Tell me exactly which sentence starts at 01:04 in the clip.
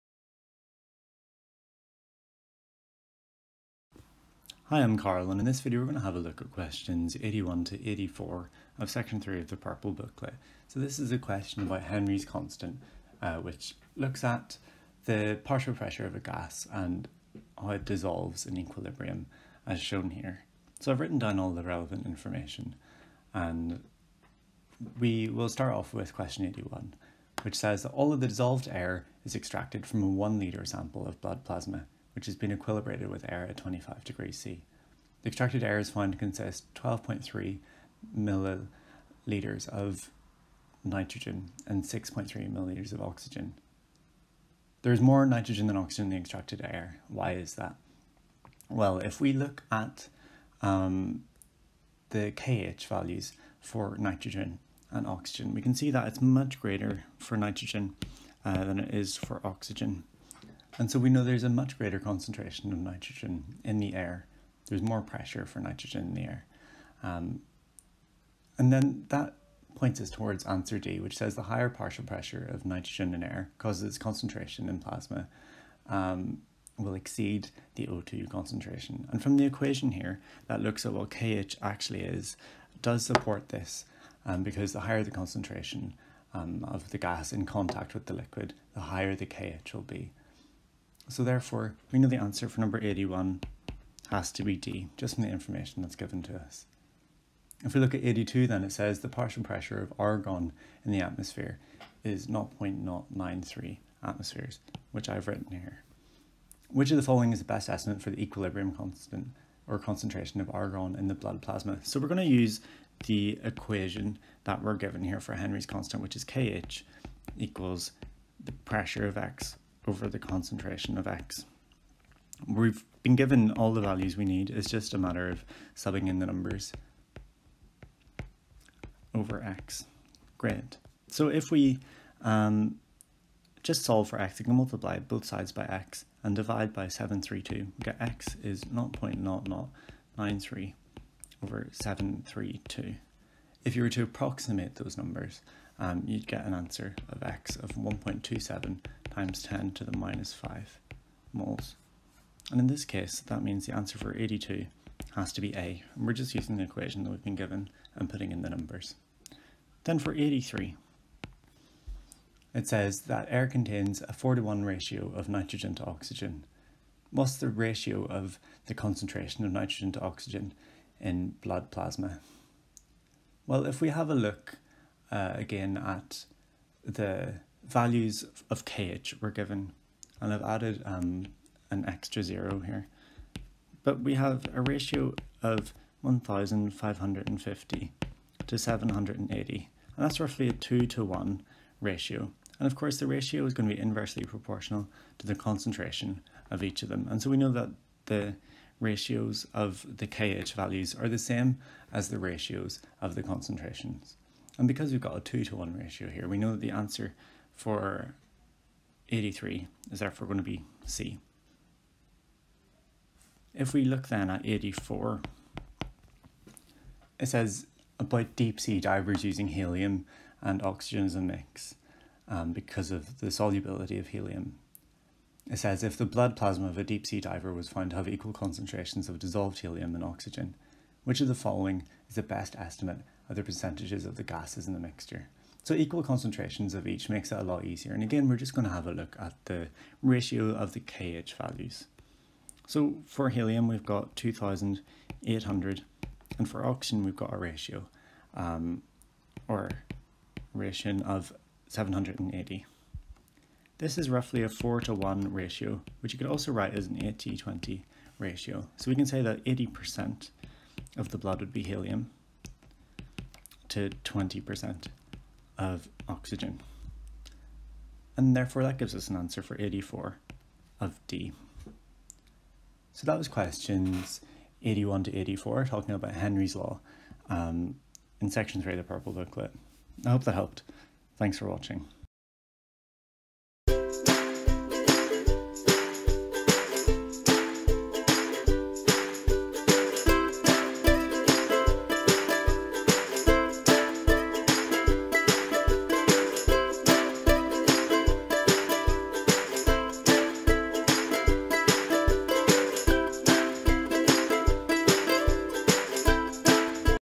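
There's more pressure for nitrogen in the air.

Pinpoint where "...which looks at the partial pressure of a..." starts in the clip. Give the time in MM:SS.
00:13.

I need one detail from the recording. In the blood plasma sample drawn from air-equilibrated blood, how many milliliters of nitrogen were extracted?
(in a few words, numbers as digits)
12.3 milliliters.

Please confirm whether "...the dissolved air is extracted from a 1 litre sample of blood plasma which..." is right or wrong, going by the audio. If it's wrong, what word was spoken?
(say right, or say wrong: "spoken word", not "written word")
right.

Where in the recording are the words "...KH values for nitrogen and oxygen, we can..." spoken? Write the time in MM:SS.
00:52.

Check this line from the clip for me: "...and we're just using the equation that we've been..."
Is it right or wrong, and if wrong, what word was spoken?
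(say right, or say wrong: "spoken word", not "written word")
right.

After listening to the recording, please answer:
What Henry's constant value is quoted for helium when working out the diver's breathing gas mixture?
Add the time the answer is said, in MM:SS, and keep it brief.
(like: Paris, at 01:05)
2,800, at 04:04.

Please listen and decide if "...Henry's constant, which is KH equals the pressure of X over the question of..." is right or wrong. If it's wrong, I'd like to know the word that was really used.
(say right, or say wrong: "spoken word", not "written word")
wrong: "concentration", not "question".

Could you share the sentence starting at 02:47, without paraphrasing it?
What's the ratio of the concentration of nitrogen to oxygen in blood plasma?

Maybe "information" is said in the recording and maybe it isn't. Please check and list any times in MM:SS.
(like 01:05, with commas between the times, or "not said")
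00:22, 01:35.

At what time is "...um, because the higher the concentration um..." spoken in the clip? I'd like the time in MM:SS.
01:24.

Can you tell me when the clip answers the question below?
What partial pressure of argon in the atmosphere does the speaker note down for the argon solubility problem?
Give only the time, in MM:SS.
01:42.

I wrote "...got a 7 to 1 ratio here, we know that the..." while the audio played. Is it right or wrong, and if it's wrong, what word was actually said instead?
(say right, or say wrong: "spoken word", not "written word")
wrong: "2", not "7".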